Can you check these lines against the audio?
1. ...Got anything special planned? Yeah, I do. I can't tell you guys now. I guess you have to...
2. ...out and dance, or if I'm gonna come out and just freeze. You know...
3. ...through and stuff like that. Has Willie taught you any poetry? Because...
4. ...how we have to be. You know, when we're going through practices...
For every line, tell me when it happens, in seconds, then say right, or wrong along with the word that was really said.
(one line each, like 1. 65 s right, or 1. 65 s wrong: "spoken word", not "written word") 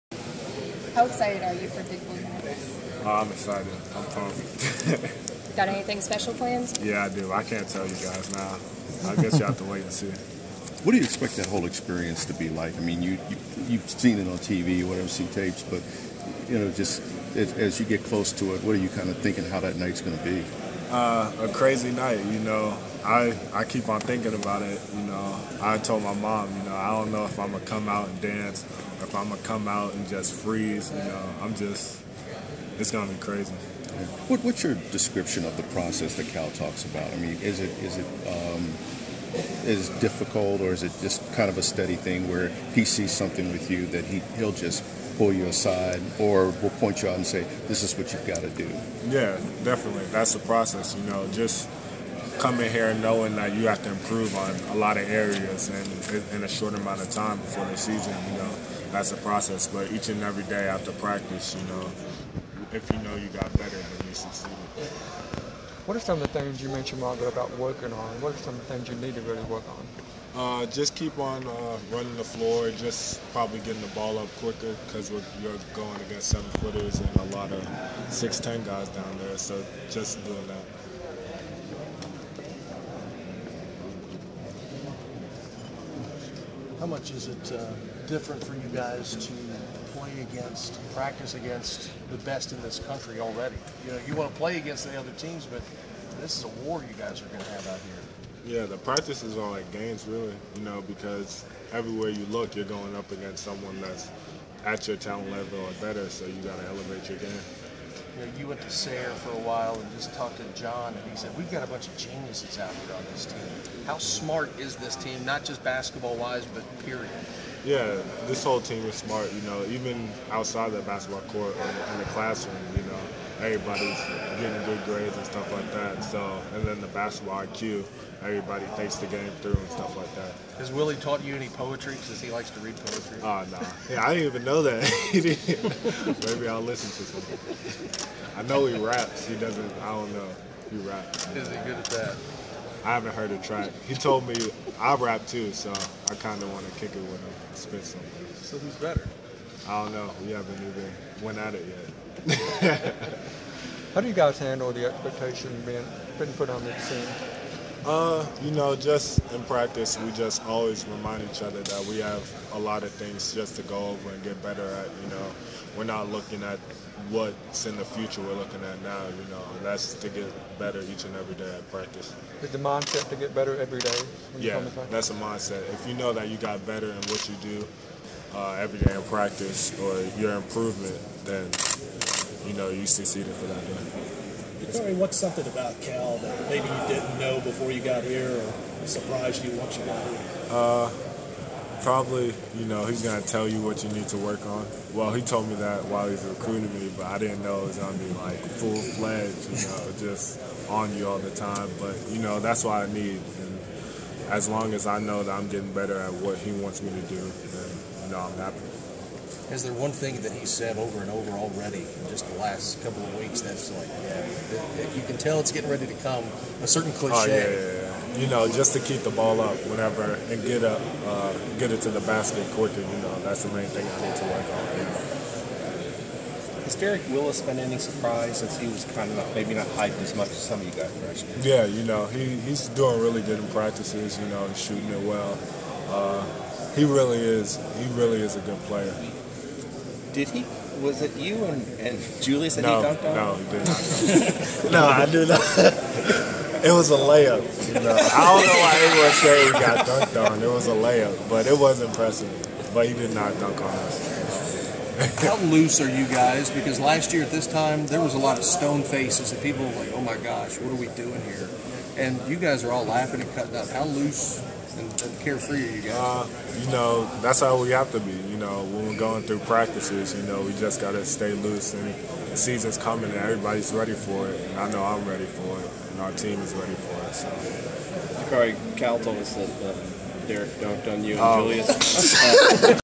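1. 5 s right
2. 27 s right
3. 129 s right
4. 267 s right.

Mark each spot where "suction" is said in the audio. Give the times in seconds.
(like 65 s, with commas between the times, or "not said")
not said.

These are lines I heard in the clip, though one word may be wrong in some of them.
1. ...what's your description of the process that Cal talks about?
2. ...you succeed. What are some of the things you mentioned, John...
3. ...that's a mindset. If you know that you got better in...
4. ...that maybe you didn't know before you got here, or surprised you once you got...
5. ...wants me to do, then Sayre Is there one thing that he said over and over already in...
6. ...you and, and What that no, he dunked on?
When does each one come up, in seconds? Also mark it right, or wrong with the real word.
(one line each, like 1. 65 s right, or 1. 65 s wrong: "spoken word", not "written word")
1. 34 s right
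2. 64 s wrong: "Margaret", not "John"
3. 174 s right
4. 186 s right
5. 206 s wrong: "Dom", not "Sayre"
6. 241 s wrong: "Julius", not "What".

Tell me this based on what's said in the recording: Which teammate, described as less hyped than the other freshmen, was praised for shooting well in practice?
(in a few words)
Derek Willis.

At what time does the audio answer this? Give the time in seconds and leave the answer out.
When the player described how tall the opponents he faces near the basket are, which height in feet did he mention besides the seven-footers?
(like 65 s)
78 s.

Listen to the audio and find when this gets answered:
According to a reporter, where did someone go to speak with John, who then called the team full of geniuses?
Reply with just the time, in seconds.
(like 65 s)
108 s.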